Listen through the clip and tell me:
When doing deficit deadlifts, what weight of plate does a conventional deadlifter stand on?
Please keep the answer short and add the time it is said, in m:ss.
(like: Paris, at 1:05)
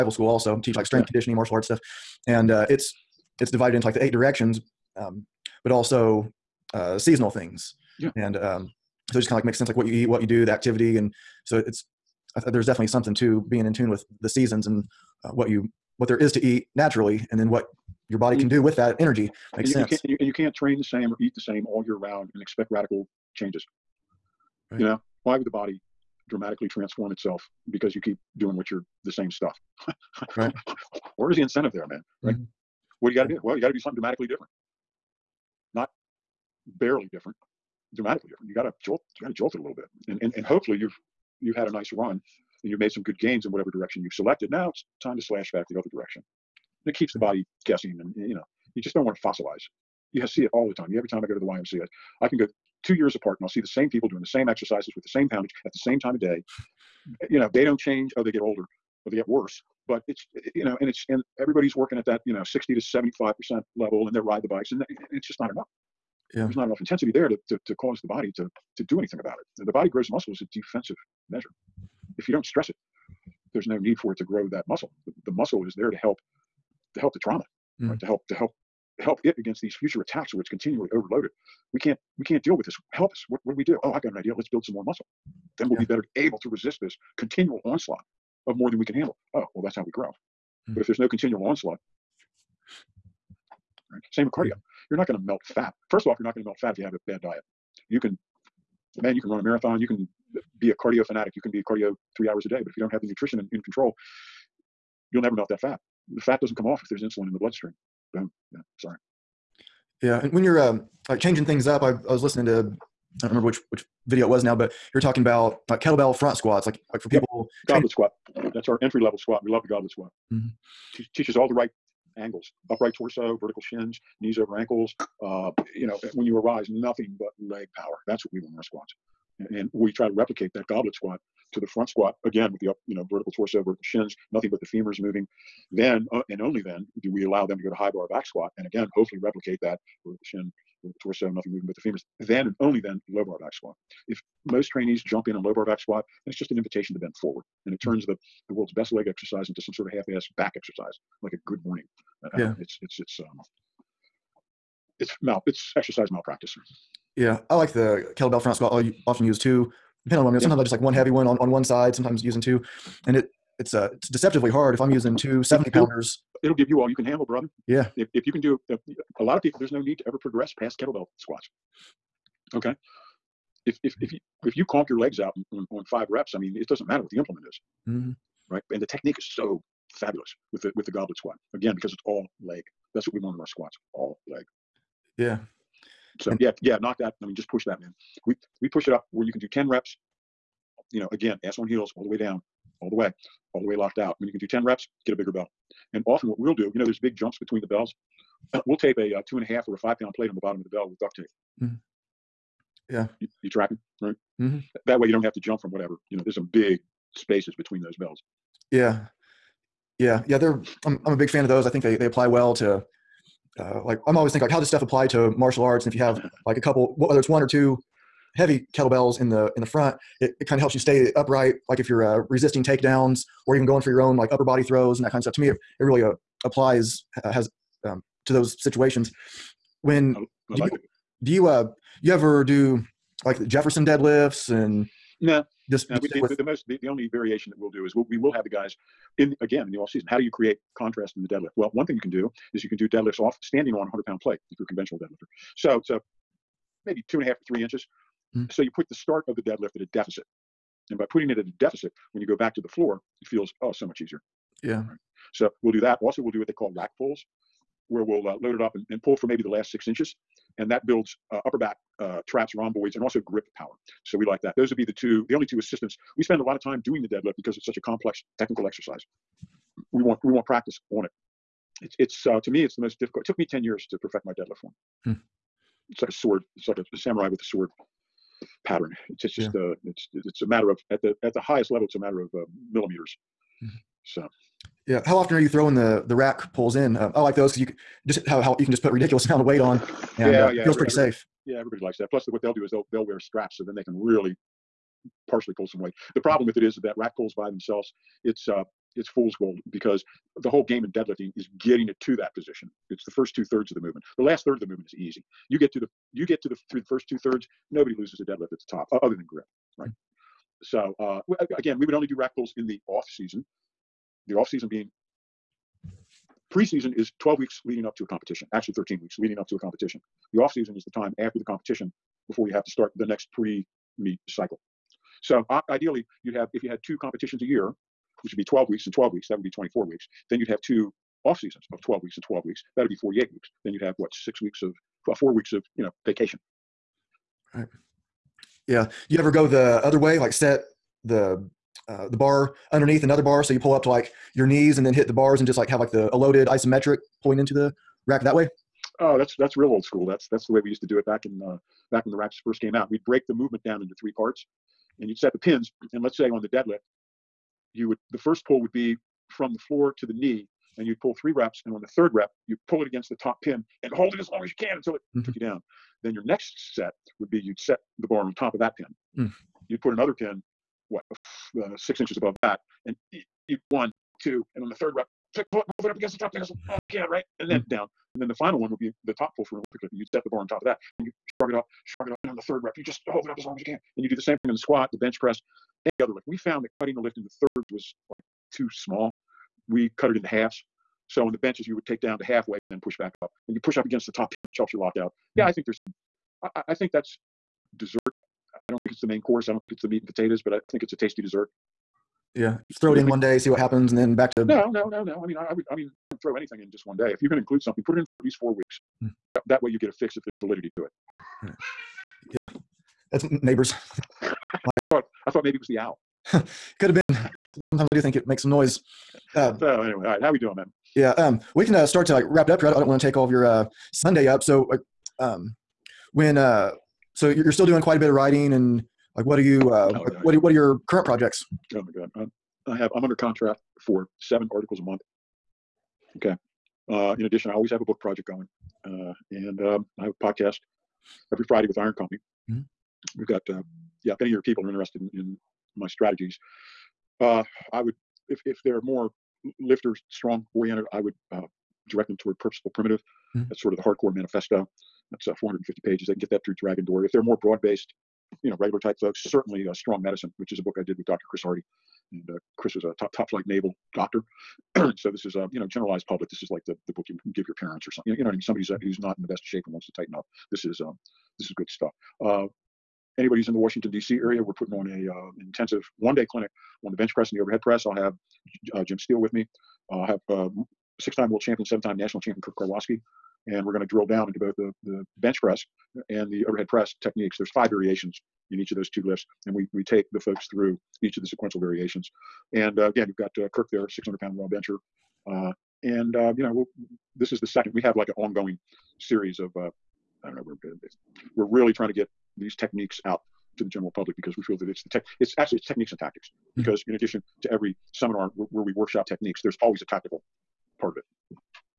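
100 pounds, at 4:03.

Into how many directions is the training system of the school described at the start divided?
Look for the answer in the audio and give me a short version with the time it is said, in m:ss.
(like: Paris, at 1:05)
8, at 0:04.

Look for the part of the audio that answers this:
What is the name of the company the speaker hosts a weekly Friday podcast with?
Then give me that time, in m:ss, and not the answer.
7:21.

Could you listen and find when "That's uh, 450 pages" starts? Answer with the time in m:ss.
7:35.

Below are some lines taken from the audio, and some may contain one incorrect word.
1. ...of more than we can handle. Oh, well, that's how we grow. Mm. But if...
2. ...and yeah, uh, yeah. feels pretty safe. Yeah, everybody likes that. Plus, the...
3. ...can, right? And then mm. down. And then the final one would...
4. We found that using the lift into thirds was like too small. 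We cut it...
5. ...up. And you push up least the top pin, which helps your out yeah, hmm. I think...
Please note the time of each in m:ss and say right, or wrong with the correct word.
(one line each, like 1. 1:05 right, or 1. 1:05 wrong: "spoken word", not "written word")
1. 1:28 right
2. 4:50 right
3. 6:16 right
4. 6:26 wrong: "cutting", not "using"
5. 6:33 wrong: "against", not "least".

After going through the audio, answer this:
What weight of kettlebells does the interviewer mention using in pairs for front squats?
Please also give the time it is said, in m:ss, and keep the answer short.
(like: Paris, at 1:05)
70 pounds, at 2:45.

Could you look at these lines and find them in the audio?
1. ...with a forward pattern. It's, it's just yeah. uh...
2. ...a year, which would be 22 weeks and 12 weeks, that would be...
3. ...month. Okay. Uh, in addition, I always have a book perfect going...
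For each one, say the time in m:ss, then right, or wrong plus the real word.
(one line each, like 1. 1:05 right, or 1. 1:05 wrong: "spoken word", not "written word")
1. 4:37 wrong: "sword", not "forward"
2. 5:27 wrong: "12", not "22"
3. 7:14 wrong: "project", not "perfect".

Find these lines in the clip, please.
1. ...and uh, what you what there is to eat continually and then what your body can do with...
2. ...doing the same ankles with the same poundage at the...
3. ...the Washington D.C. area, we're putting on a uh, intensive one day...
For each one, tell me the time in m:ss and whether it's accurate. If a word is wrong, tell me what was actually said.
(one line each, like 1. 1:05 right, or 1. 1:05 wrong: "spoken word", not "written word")
1. 0:14 wrong: "naturally", not "continually"
2. 0:54 wrong: "exercises", not "ankles"
3. 7:53 right.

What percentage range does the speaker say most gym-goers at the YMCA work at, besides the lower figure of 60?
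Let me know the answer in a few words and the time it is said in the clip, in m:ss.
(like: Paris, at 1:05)
75 percent, at 1:02.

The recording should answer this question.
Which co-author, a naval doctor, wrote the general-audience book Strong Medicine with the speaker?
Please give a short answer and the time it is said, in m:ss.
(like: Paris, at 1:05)
Chris Hardy, at 7:41.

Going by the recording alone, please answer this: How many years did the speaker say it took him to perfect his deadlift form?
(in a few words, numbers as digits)
10 years.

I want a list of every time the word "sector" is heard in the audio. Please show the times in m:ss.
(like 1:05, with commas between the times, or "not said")
not said.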